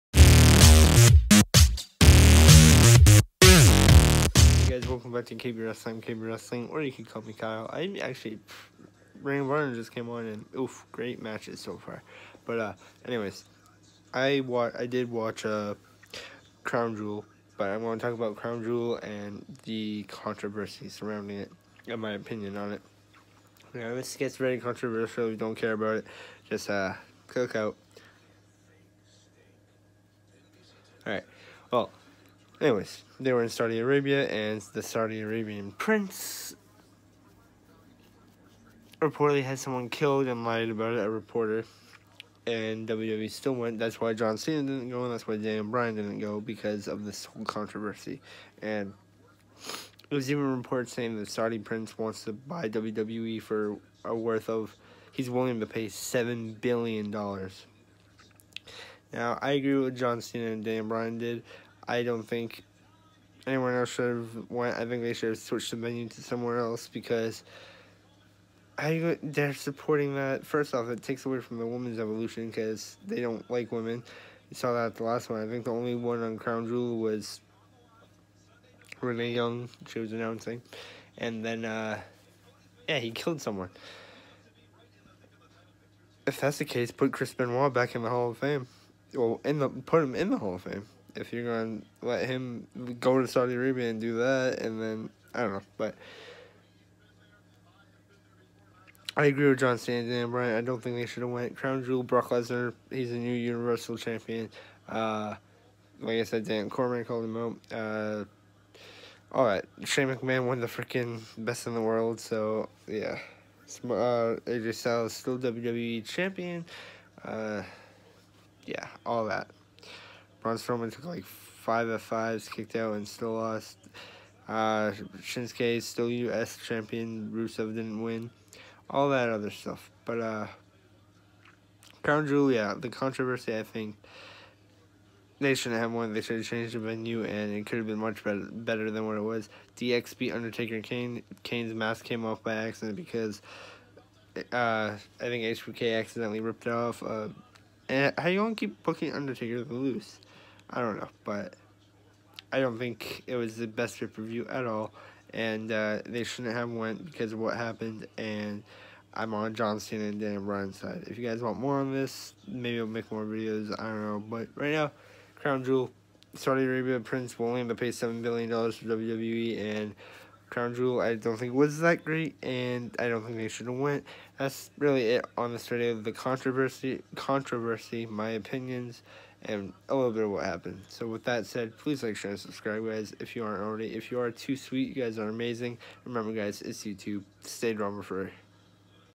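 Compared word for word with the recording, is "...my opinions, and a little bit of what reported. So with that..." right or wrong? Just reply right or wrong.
wrong.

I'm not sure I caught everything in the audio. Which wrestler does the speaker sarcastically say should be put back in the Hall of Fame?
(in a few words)
Chris Benoit.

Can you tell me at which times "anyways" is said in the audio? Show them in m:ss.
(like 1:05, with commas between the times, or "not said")
0:13, 0:32.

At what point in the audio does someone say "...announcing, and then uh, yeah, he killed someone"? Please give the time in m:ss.
1:20.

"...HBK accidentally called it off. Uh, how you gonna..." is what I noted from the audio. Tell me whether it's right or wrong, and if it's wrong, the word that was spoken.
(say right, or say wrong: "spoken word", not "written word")
wrong: "ripped", not "called".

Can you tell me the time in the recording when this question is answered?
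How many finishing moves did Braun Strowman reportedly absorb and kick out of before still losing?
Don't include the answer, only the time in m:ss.
2:01.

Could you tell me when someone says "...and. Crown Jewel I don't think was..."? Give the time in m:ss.
2:49.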